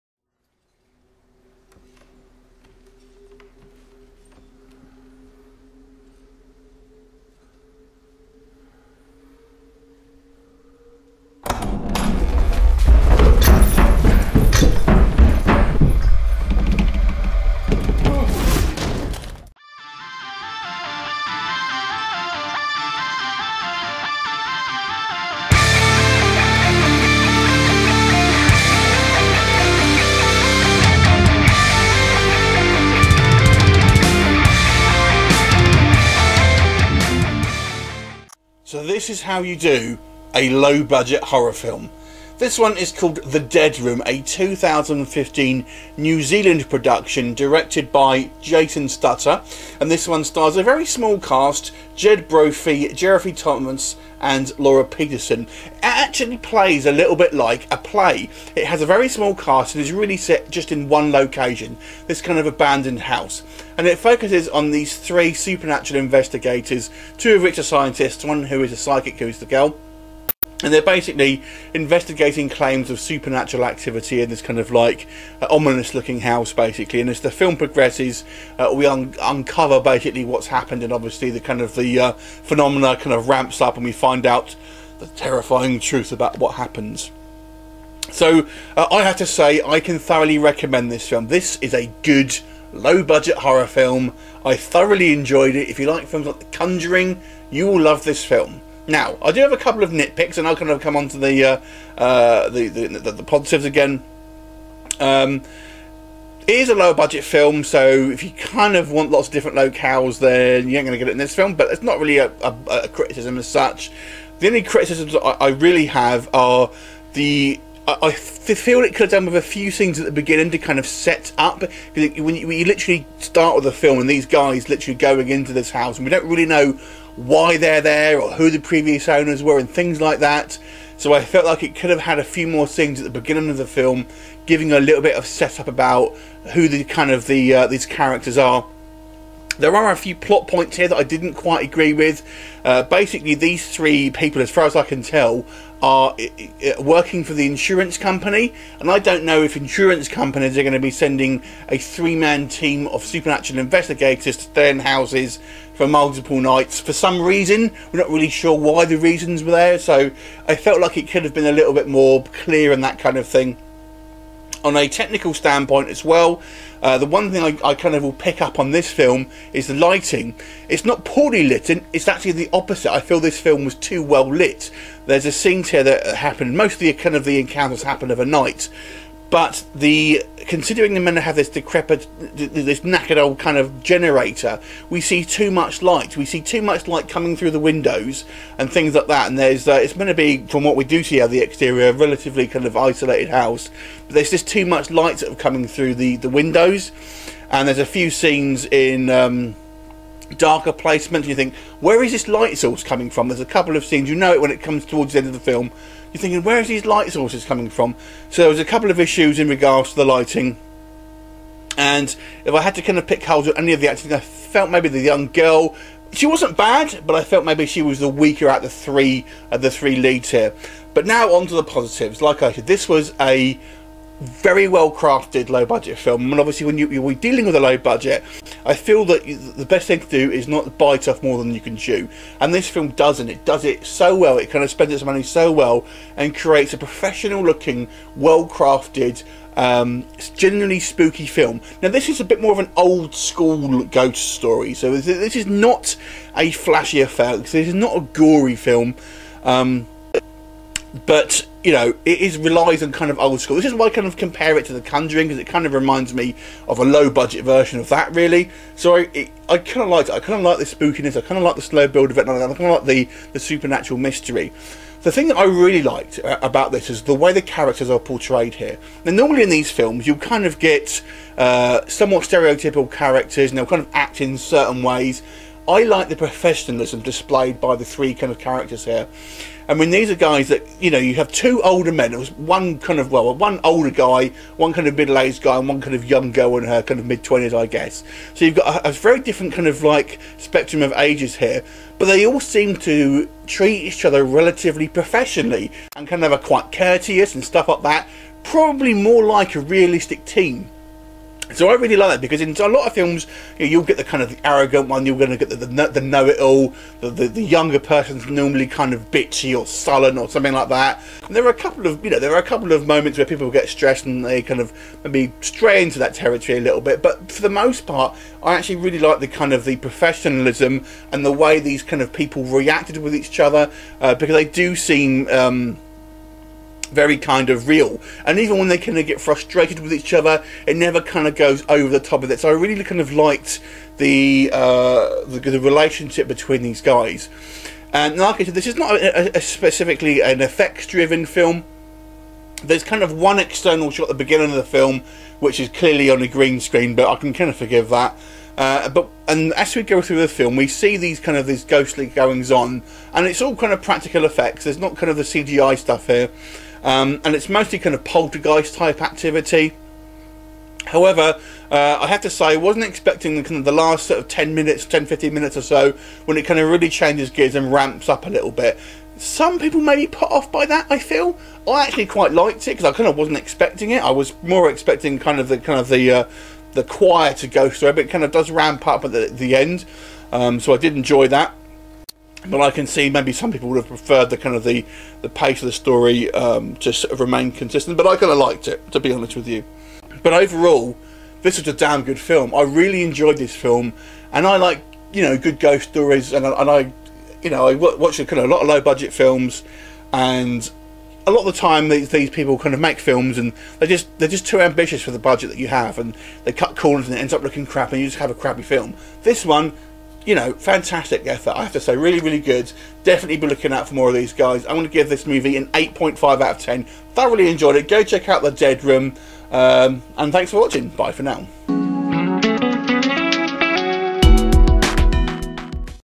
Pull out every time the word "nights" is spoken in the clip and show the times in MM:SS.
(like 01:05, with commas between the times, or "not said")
02:36, 02:58.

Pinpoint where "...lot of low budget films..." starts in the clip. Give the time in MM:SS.
06:38.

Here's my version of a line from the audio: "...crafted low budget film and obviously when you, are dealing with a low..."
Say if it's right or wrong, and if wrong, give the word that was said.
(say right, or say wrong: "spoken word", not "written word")
right.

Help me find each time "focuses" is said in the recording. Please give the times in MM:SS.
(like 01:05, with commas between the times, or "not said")
01:03.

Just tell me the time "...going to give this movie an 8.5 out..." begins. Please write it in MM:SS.
06:54.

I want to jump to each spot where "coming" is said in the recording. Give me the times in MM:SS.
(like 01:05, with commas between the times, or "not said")
03:07, 03:15, 03:22, 03:27.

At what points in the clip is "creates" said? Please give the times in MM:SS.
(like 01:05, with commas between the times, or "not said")
03:56.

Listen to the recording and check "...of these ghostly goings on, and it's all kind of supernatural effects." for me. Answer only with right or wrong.
wrong.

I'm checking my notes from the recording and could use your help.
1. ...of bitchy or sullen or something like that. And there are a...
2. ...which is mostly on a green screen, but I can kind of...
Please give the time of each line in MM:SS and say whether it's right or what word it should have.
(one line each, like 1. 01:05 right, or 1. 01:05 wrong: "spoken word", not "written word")
1. 05:08 right
2. 05:45 wrong: "clearly", not "mostly".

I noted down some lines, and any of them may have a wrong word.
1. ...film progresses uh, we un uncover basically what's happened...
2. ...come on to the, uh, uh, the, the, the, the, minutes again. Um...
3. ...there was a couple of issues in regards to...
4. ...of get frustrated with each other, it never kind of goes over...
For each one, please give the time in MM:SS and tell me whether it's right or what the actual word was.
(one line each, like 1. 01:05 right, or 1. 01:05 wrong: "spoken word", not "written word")
1. 01:17 right
2. 01:40 wrong: "positives", not "minutes"
3. 03:28 right
4. 05:28 right.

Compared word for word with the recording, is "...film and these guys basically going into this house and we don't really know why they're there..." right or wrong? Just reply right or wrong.
wrong.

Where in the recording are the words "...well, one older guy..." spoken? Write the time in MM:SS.
04:43.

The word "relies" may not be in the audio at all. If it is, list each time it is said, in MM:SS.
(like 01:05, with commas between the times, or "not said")
04:12.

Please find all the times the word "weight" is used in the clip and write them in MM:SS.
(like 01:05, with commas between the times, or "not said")
not said.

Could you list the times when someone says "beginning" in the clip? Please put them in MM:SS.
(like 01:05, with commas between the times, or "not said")
02:00, 02:13, 05:44.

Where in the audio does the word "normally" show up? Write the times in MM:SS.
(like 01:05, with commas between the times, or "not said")
04:29, 05:08.